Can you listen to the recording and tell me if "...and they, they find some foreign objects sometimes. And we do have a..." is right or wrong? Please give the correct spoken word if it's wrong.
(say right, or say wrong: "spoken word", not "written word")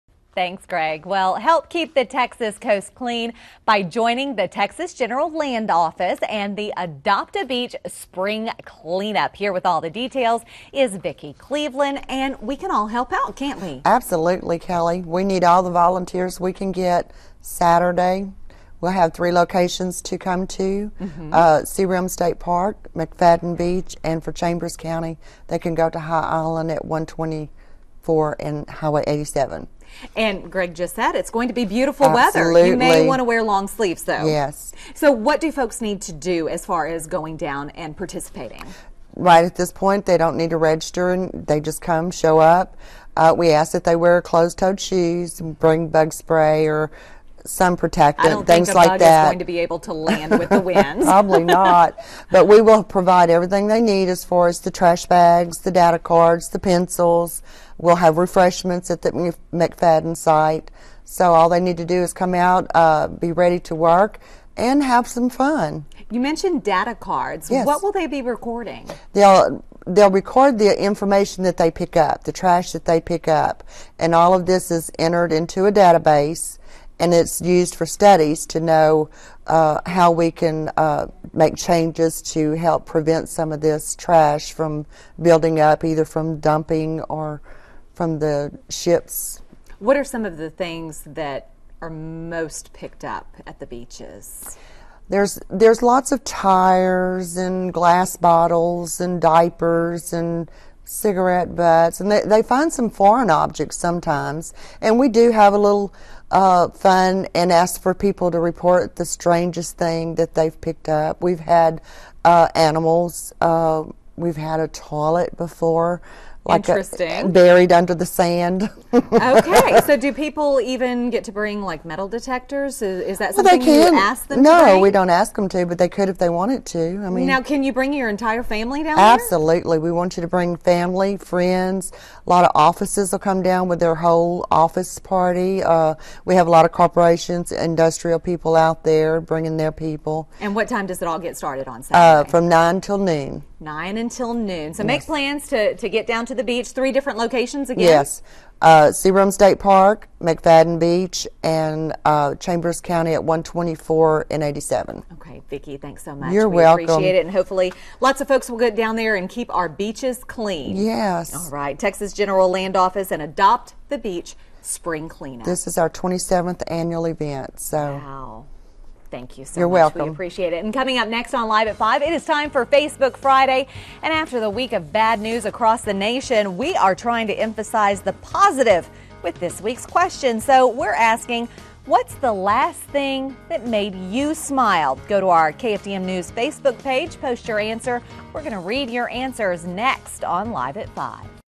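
right.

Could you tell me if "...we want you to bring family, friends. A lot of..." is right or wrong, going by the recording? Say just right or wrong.
right.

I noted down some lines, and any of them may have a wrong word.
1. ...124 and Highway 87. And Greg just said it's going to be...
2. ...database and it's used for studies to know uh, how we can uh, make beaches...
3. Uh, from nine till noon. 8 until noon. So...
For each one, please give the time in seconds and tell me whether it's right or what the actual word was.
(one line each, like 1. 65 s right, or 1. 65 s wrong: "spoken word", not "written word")
1. 26 s right
2. 75 s wrong: "changes", not "beaches"
3. 142 s wrong: "9", not "8".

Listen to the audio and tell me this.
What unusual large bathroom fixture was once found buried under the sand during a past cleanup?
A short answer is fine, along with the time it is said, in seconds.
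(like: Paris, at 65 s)
a toilet, at 114 s.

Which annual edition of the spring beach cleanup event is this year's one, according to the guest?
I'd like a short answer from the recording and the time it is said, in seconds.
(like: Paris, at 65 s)
27th, at 165 s.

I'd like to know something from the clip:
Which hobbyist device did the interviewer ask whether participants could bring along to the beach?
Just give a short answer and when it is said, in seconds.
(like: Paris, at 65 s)
metal detectors, at 121 s.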